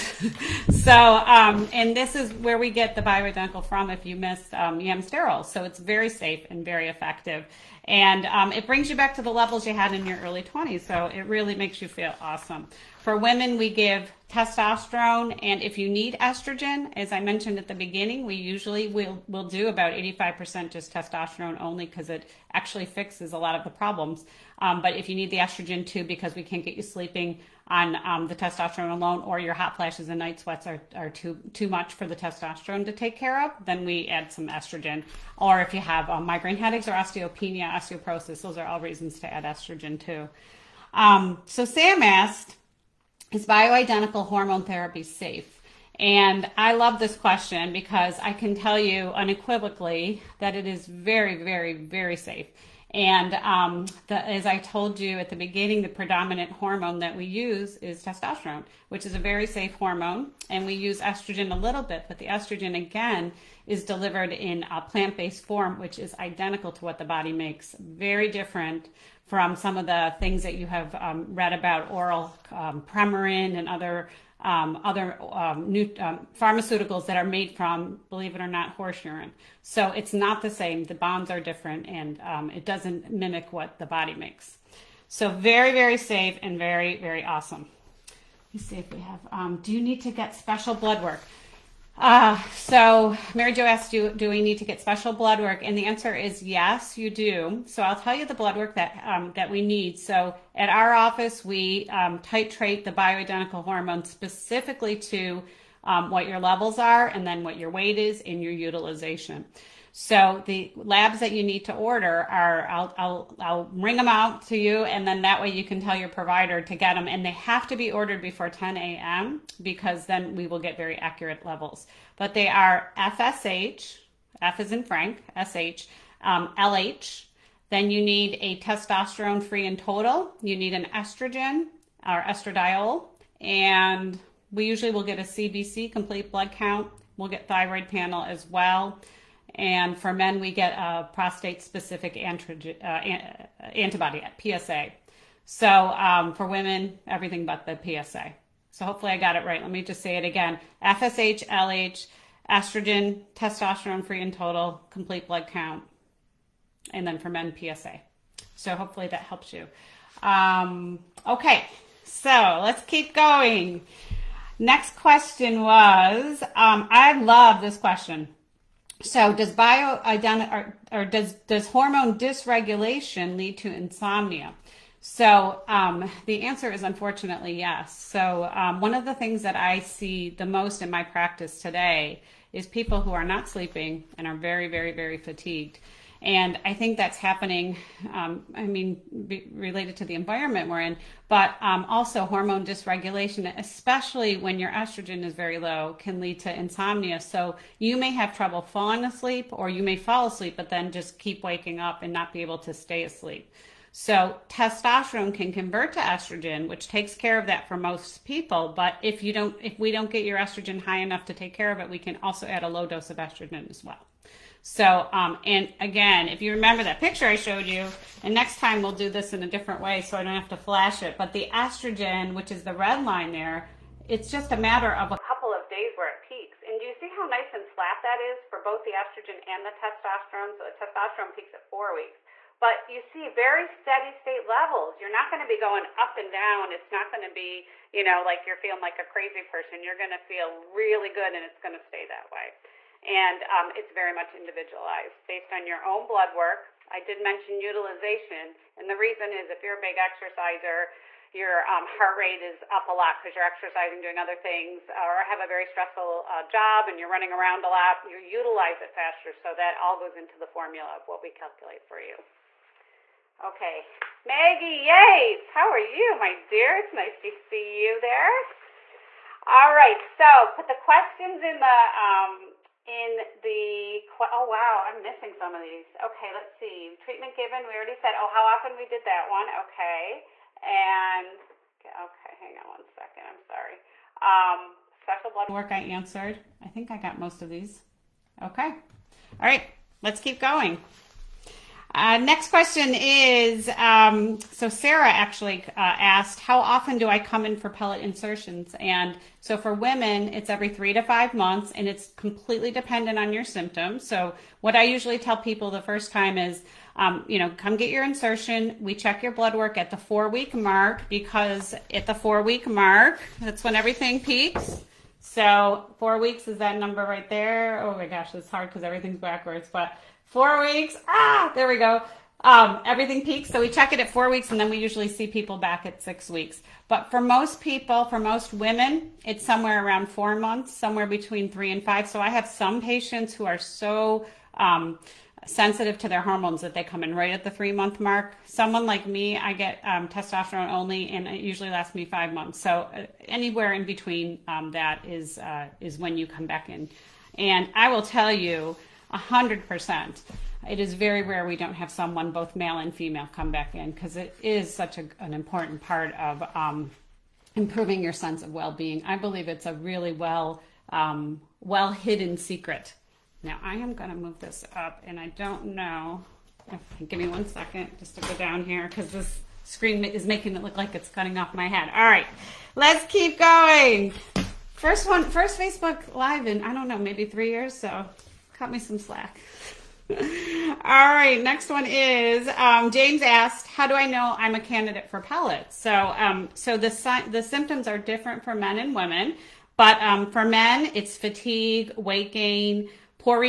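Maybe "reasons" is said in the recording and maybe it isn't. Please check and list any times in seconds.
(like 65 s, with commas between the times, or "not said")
38 s, 248 s.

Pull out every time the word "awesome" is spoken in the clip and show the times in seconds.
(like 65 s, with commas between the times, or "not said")
12 s, 87 s.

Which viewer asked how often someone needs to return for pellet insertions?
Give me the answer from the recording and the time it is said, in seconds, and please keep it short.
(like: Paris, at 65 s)
Sarah, at 294 s.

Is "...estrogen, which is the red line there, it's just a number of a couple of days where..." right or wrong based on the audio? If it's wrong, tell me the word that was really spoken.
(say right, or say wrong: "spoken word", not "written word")
wrong: "matter", not "number".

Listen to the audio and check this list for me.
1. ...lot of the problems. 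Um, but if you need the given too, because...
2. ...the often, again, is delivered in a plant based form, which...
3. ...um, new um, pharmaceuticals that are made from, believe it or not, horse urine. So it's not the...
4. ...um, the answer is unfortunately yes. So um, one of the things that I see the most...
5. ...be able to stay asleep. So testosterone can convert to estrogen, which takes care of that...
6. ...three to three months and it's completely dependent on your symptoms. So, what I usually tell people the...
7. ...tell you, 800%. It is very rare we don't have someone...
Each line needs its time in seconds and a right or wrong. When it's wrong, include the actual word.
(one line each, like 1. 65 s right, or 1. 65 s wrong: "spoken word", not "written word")
1. 23 s wrong: "estrogen", not "given"
2. 62 s wrong: "estrogen", not "often"
3. 75 s right
4. 175 s right
5. 202 s right
6. 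300 s wrong: "five", not "three"
7. 348 s wrong: "100", not "800".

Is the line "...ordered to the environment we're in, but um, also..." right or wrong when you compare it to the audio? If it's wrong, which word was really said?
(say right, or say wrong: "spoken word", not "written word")
wrong: "related", not "ordered".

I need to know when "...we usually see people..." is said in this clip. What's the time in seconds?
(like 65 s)
324 s.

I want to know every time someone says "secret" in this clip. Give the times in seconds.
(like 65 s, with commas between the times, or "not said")
362 s.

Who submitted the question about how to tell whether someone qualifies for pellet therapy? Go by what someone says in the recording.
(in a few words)
James.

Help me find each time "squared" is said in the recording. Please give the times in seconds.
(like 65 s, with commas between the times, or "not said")
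not said.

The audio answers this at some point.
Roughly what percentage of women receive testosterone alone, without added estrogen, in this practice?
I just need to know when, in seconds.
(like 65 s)
19 s.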